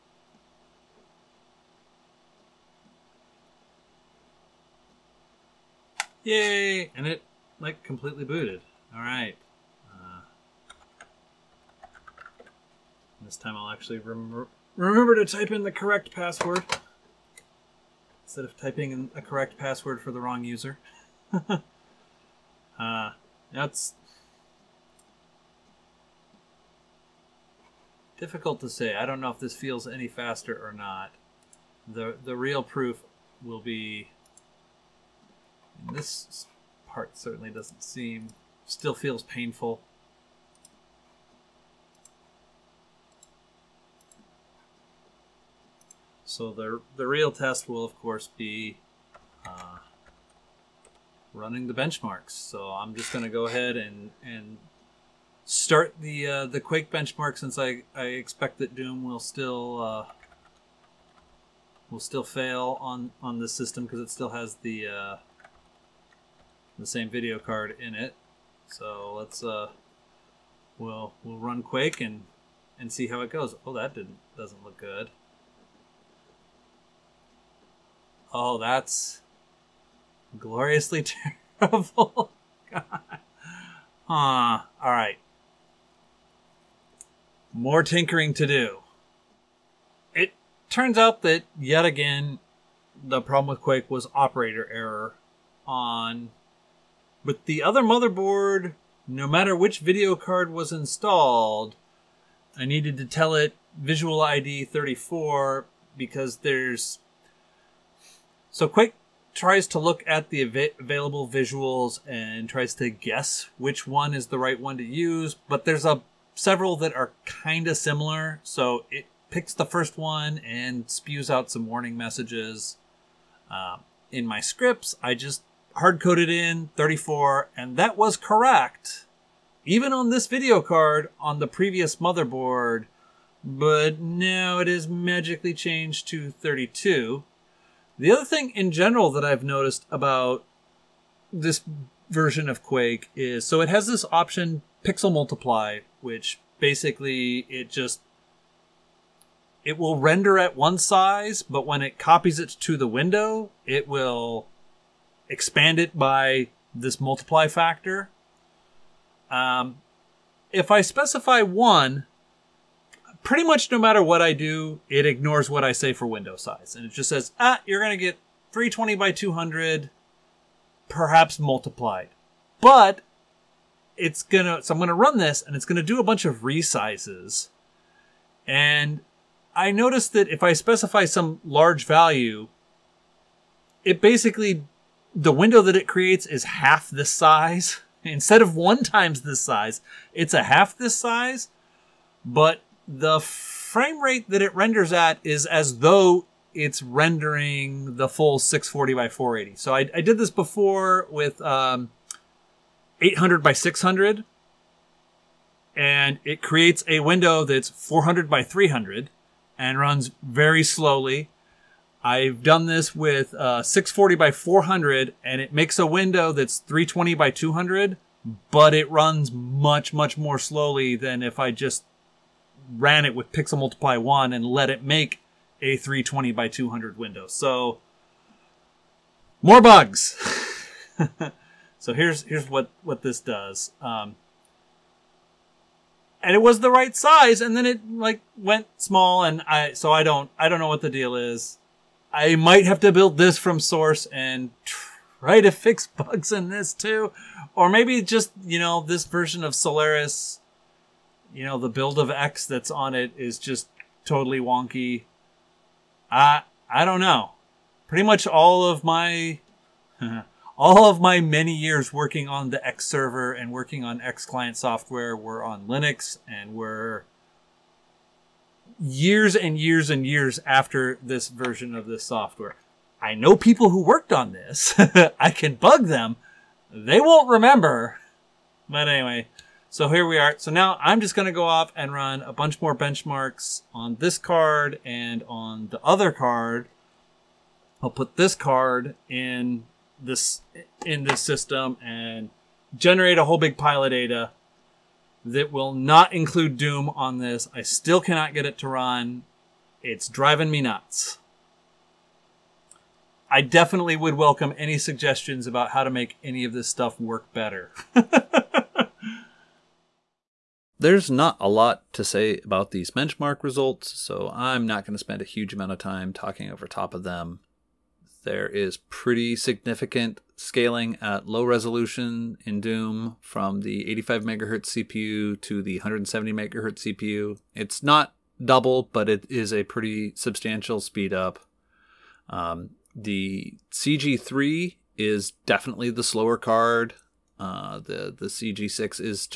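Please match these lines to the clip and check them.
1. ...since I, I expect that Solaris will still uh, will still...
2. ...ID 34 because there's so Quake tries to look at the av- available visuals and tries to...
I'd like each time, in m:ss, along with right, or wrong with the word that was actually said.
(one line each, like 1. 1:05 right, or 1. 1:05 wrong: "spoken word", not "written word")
1. 0:57 wrong: "Doom", not "Solaris"
2. 1:44 right.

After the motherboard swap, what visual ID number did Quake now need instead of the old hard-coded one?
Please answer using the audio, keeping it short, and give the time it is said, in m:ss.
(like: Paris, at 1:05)
32, at 2:14.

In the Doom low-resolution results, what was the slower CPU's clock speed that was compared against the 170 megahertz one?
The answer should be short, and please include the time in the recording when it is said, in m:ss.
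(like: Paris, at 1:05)
85 megahertz, at 5:23.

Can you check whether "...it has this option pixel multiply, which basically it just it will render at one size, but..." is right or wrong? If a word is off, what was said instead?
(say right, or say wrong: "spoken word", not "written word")
right.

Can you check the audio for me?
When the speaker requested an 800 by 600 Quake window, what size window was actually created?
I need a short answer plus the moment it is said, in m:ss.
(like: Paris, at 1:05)
400 by 300, at 3:27.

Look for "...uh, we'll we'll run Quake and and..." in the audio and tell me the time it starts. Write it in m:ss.
1:09.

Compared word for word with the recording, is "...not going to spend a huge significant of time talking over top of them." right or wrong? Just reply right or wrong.
wrong.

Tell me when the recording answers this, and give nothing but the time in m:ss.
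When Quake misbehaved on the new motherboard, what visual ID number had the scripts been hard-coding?
2:05.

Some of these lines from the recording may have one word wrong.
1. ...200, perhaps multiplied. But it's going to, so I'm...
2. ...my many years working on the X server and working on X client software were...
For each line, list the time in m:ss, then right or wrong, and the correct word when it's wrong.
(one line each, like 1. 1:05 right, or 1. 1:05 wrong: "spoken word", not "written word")
1. 2:49 right
2. 4:21 right.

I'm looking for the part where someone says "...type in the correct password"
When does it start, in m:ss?
0:15.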